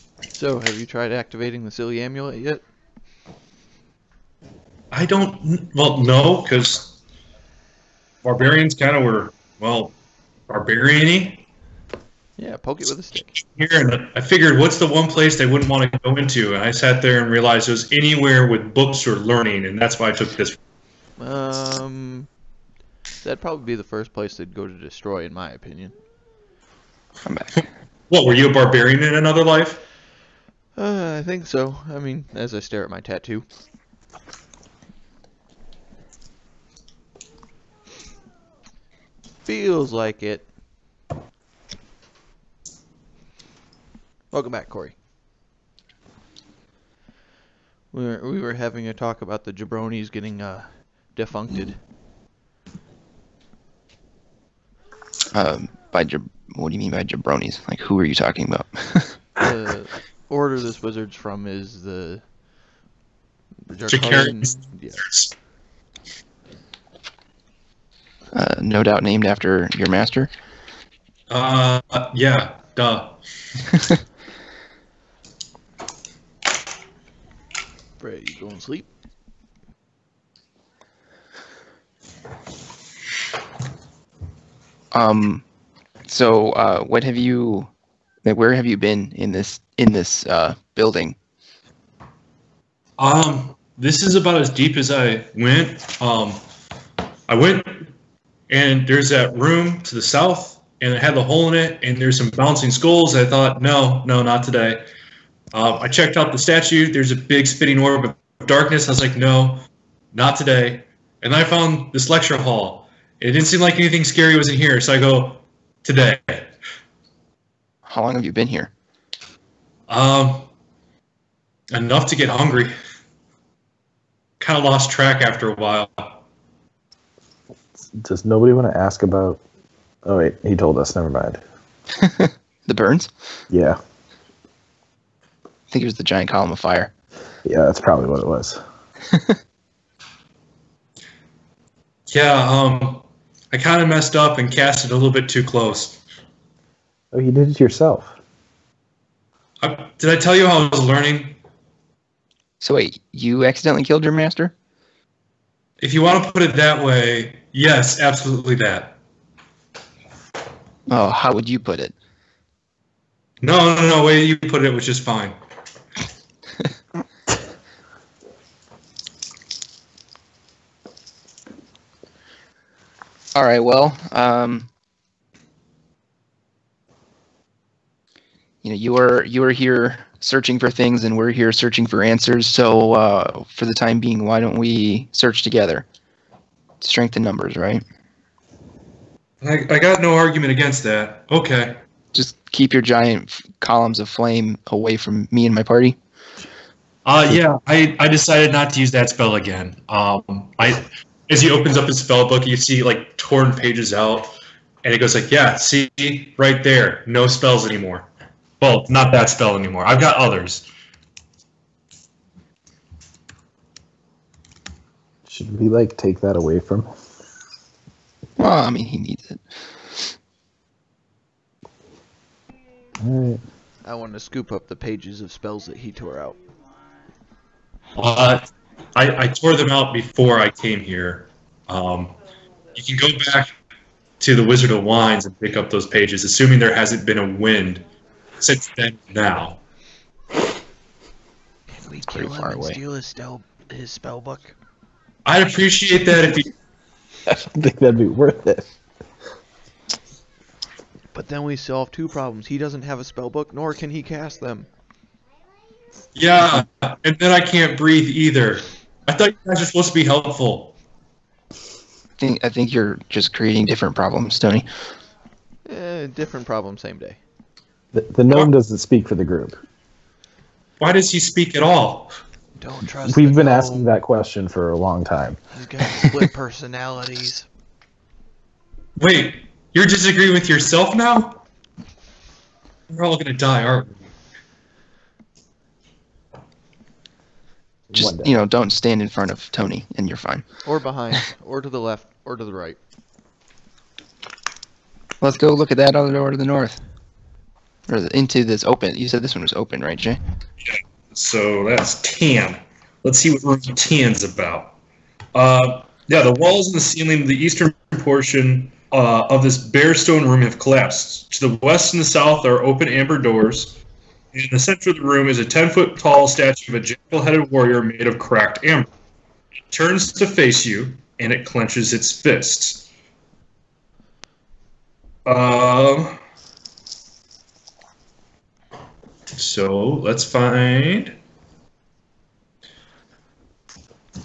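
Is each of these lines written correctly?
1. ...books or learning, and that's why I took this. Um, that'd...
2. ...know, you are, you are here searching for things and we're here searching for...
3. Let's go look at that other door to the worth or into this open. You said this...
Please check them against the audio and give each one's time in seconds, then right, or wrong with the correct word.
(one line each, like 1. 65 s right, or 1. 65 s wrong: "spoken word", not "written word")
1. 18 s right
2. 178 s right
3. 295 s wrong: "north", not "worth".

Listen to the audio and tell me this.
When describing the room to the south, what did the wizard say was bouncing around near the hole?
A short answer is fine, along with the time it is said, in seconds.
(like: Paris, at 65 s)
skulls, at 102 s.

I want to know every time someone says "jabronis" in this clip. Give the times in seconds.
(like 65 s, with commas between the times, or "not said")
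49 s, 57 s.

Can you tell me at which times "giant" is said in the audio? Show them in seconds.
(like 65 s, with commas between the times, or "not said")
136 s, 192 s.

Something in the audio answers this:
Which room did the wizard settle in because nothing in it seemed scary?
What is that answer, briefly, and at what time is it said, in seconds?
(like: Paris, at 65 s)
lecture hall, at 112 s.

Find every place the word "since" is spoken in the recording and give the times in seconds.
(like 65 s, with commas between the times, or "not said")
238 s.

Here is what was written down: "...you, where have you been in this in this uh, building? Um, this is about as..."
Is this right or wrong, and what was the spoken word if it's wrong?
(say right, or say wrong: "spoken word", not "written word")
right.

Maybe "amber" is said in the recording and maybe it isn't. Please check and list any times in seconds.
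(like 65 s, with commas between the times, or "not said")
312 s, 318 s.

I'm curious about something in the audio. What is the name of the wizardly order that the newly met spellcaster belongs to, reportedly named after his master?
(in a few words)
Jacarians.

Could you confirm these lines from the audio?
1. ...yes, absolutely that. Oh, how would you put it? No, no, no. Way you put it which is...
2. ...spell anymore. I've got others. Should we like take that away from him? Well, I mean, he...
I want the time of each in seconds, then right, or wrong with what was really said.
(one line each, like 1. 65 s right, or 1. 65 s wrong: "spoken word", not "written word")
1. 157 s right
2. 209 s right.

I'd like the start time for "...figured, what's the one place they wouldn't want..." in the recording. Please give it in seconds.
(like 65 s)
14 s.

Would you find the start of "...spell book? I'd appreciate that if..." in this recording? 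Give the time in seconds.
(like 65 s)
243 s.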